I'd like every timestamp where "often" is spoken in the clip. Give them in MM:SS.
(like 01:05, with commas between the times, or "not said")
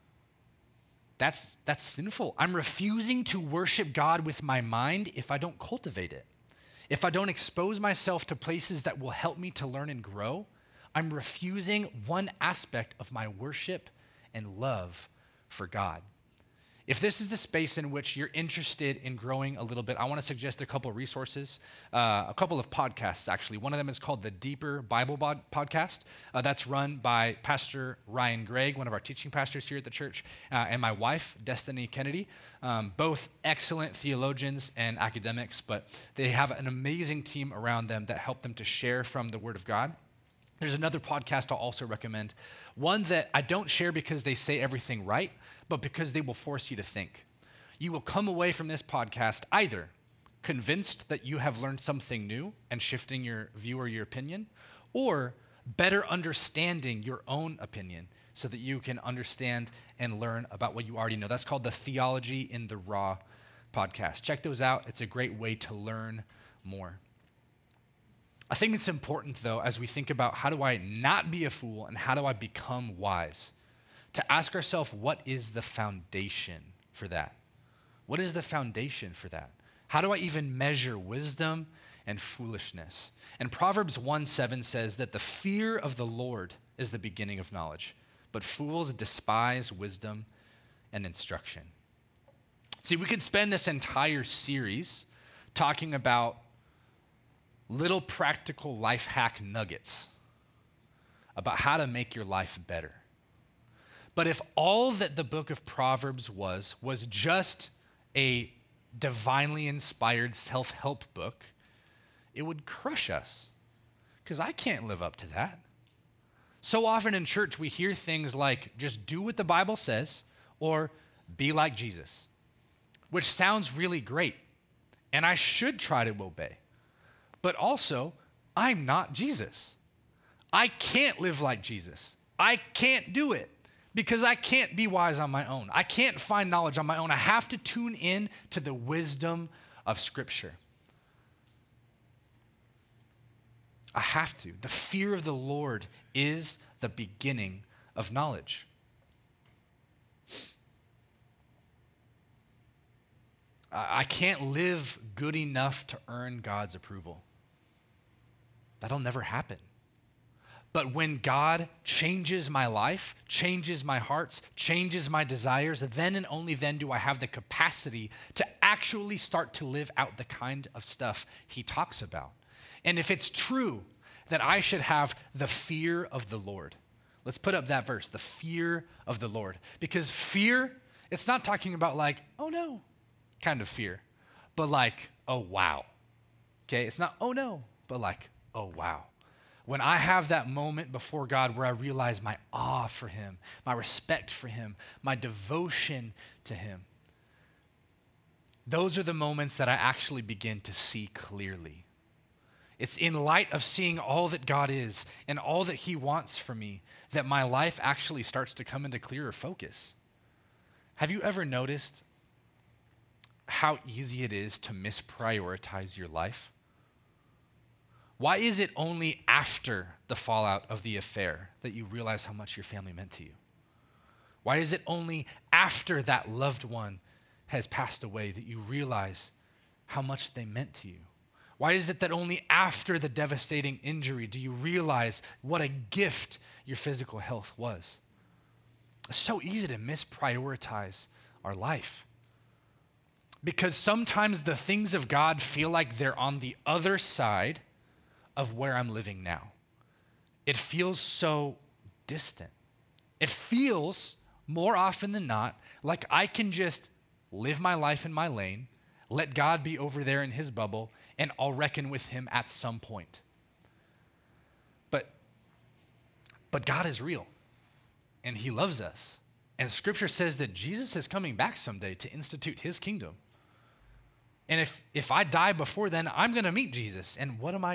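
01:56, 04:14.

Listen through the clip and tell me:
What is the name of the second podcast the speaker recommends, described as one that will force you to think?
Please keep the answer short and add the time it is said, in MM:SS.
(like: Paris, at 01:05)
Theology in the Raw, at 01:01.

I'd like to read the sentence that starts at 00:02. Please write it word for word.
I'm refusing to worship God with my mind if I don't cultivate it.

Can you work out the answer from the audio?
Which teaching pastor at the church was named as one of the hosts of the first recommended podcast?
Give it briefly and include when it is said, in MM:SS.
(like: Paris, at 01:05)
Ryan Gregg, at 00:28.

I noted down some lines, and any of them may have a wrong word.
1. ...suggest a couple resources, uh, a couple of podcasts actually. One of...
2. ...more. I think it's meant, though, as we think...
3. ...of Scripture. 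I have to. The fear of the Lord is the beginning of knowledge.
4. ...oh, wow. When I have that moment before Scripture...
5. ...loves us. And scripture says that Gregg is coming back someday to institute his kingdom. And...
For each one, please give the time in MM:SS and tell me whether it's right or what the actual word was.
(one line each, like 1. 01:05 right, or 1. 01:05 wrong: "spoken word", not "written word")
1. 00:20 right
2. 01:06 wrong: "important", not "meant"
3. 02:19 right
4. 03:08 wrong: "God", not "Scripture"
5. 04:28 wrong: "Jesus", not "Gregg".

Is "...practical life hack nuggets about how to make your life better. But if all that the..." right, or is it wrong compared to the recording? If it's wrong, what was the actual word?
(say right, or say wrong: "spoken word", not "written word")
right.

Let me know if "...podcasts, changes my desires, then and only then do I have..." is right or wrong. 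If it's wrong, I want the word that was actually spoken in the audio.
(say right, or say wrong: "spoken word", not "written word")
wrong: "hearts", not "podcasts".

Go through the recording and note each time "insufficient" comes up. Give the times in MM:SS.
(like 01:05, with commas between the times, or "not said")
not said.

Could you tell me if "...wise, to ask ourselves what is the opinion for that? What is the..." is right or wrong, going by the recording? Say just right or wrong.
wrong.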